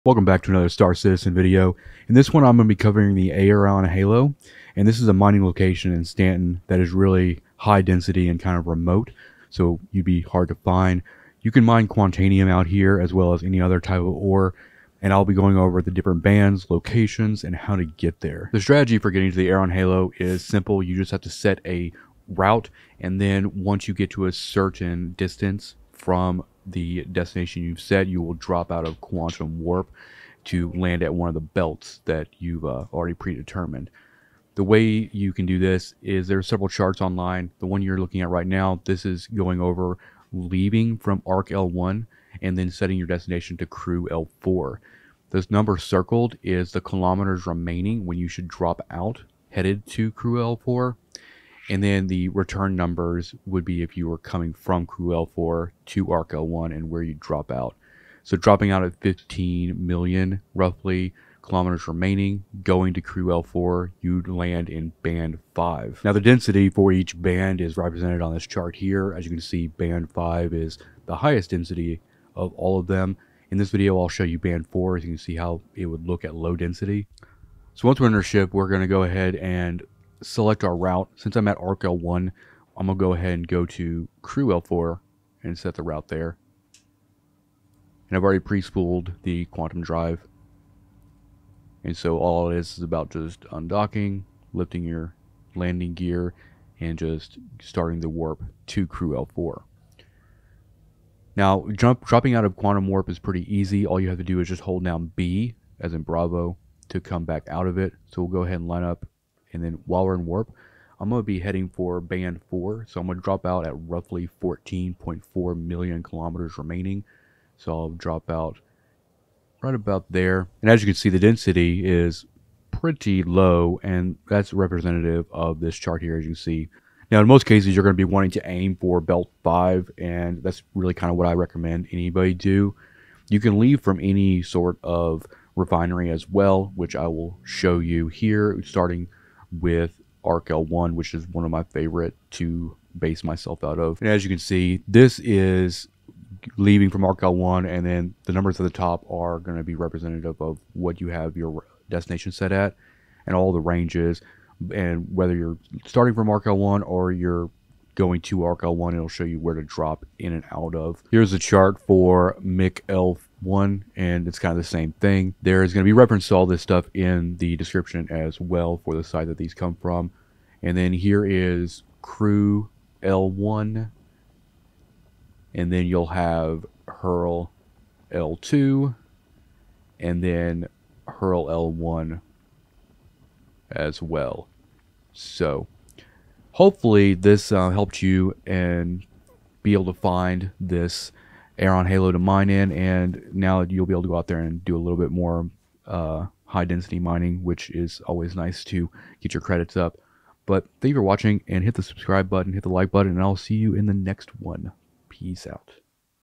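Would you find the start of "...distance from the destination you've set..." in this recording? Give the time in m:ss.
0:25.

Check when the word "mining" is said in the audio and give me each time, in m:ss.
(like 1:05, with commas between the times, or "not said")
0:05, 3:16.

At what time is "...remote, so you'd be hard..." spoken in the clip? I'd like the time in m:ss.
0:08.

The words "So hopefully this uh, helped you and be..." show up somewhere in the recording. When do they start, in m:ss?
3:05.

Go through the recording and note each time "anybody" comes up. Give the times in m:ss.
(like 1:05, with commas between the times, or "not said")
2:11.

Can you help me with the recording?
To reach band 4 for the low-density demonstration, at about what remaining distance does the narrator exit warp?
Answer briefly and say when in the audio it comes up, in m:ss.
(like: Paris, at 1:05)
14.4 million kilometers, at 1:54.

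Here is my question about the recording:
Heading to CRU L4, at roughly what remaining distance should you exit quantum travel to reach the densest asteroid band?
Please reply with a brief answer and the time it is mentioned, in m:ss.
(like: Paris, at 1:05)
15 million, at 0:59.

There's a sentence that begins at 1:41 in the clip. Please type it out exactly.
Now, jump, dropping out of quantum warp is pretty easy.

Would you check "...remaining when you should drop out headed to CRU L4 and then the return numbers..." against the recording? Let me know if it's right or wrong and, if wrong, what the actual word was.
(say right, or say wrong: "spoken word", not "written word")
right.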